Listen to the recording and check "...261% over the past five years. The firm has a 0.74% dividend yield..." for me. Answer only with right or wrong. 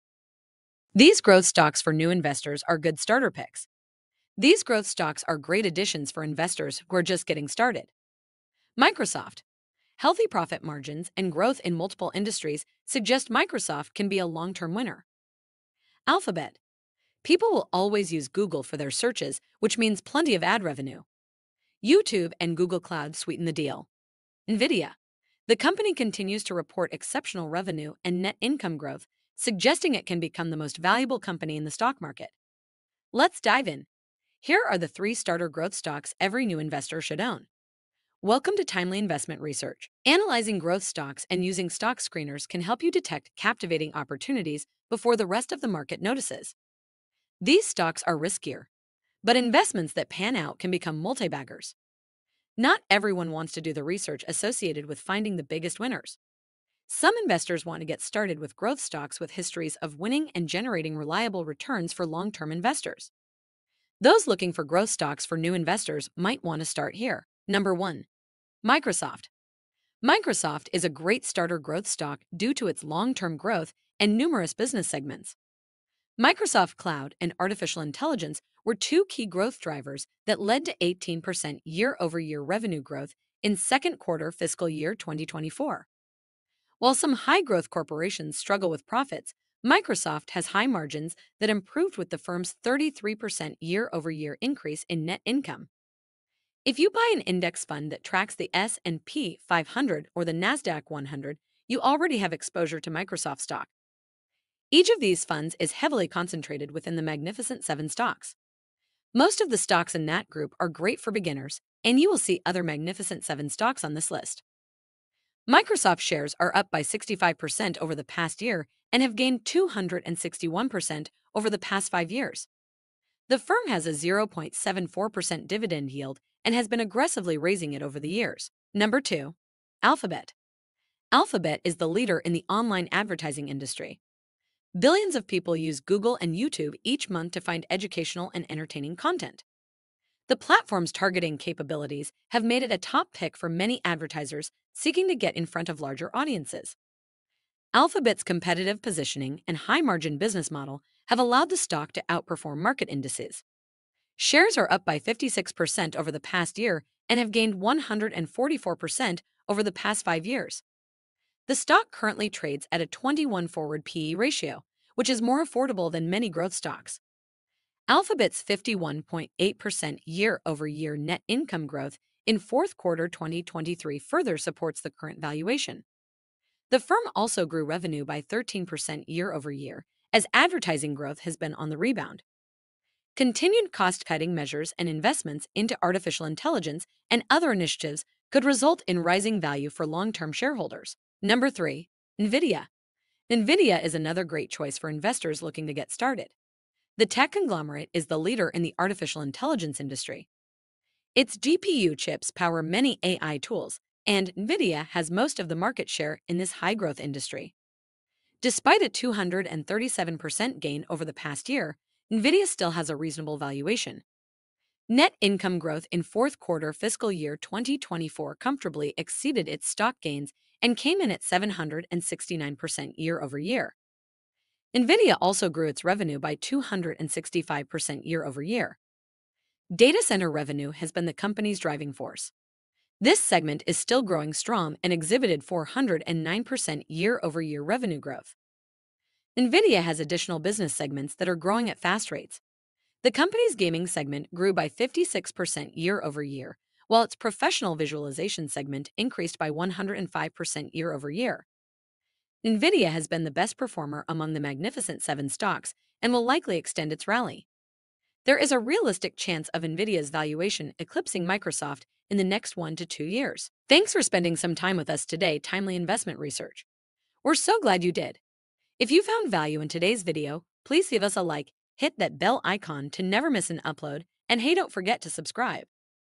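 right.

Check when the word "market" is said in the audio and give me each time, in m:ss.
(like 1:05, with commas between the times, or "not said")
0:32, 0:45, 2:32, 3:25.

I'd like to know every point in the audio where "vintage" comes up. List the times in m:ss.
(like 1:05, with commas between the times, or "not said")
not said.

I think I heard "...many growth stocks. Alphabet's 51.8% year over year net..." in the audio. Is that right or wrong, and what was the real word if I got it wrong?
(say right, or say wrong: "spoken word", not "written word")
right.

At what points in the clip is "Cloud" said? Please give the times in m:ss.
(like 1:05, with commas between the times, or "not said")
0:22, 1:16.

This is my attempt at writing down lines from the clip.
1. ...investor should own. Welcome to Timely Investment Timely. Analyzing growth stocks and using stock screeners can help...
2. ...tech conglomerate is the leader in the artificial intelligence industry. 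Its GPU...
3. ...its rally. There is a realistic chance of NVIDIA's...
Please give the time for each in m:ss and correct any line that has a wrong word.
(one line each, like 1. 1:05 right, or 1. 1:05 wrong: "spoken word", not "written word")
1. 0:36 wrong: "Research", not "Timely"
2. 3:17 right
3. 4:16 right.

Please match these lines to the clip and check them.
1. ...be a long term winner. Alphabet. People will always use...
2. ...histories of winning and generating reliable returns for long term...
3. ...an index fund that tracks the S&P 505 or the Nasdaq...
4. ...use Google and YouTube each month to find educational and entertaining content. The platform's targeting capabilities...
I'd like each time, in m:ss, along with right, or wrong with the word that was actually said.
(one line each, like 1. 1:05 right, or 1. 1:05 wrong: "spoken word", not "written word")
1. 0:14 right
2. 0:59 right
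3. 1:37 wrong: "500", not "505"
4. 2:15 right.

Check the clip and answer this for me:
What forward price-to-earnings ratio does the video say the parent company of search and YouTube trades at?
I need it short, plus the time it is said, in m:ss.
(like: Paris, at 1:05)
21, at 2:42.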